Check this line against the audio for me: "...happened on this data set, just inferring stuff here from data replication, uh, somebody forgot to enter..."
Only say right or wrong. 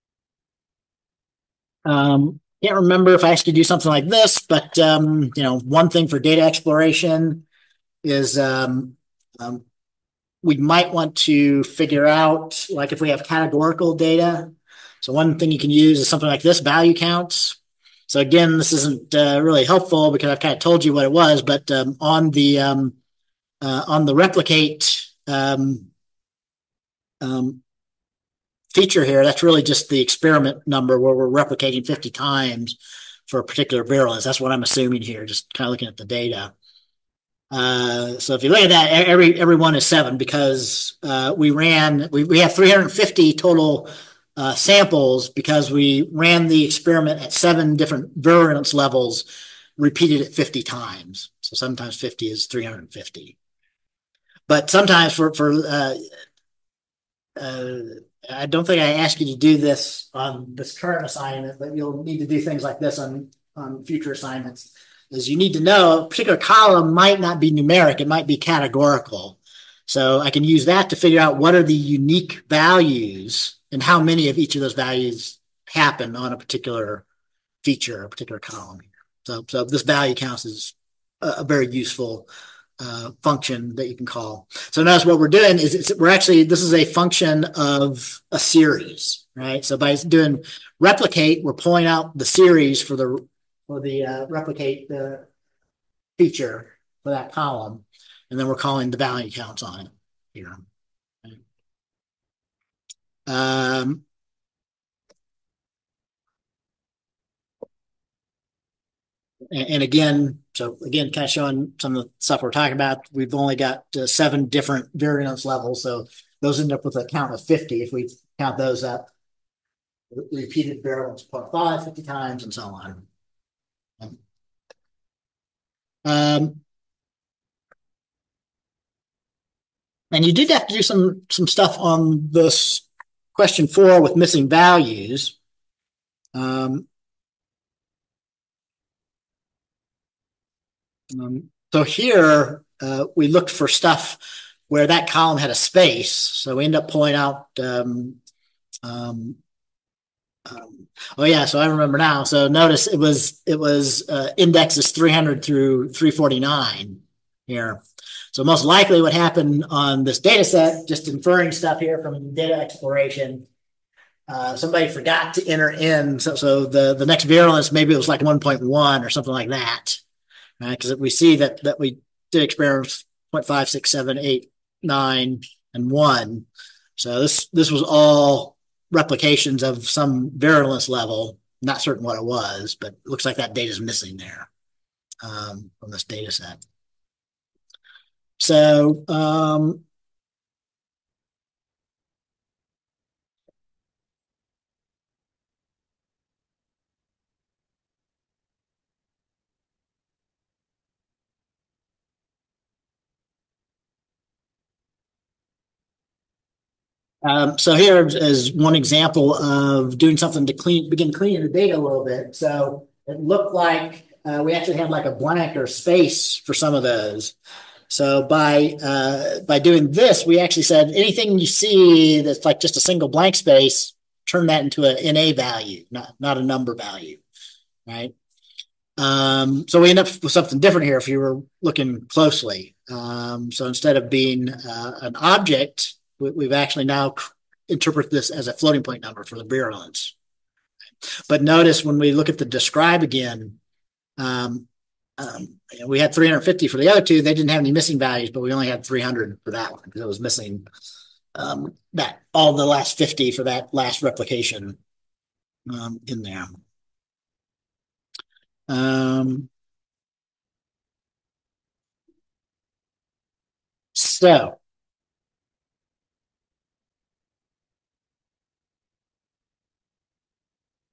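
wrong.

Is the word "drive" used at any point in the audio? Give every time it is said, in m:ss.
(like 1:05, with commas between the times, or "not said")
not said.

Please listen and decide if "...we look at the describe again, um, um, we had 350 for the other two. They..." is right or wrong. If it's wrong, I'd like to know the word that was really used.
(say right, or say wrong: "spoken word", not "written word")
right.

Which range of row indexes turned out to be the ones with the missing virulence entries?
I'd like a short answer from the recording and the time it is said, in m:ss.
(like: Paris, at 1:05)
300 through 349, at 2:34.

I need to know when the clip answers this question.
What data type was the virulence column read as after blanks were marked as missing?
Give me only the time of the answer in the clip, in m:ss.
3:58.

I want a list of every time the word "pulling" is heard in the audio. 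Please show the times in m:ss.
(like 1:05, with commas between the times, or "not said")
1:31, 2:26.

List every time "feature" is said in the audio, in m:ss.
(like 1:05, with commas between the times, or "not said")
0:28, 1:17, 1:36.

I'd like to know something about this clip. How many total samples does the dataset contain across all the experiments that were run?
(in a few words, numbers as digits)
350.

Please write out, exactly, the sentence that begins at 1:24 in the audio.
So notice what we're doing is we're actually, this is a function of a series, right?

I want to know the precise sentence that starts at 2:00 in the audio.
Repeated virulence 0.5, 50 times, and so on.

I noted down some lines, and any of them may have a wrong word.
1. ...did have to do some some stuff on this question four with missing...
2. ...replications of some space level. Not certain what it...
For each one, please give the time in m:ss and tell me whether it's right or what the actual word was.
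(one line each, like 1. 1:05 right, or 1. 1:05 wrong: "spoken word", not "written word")
1. 2:10 right
2. 2:58 wrong: "virulence", not "space".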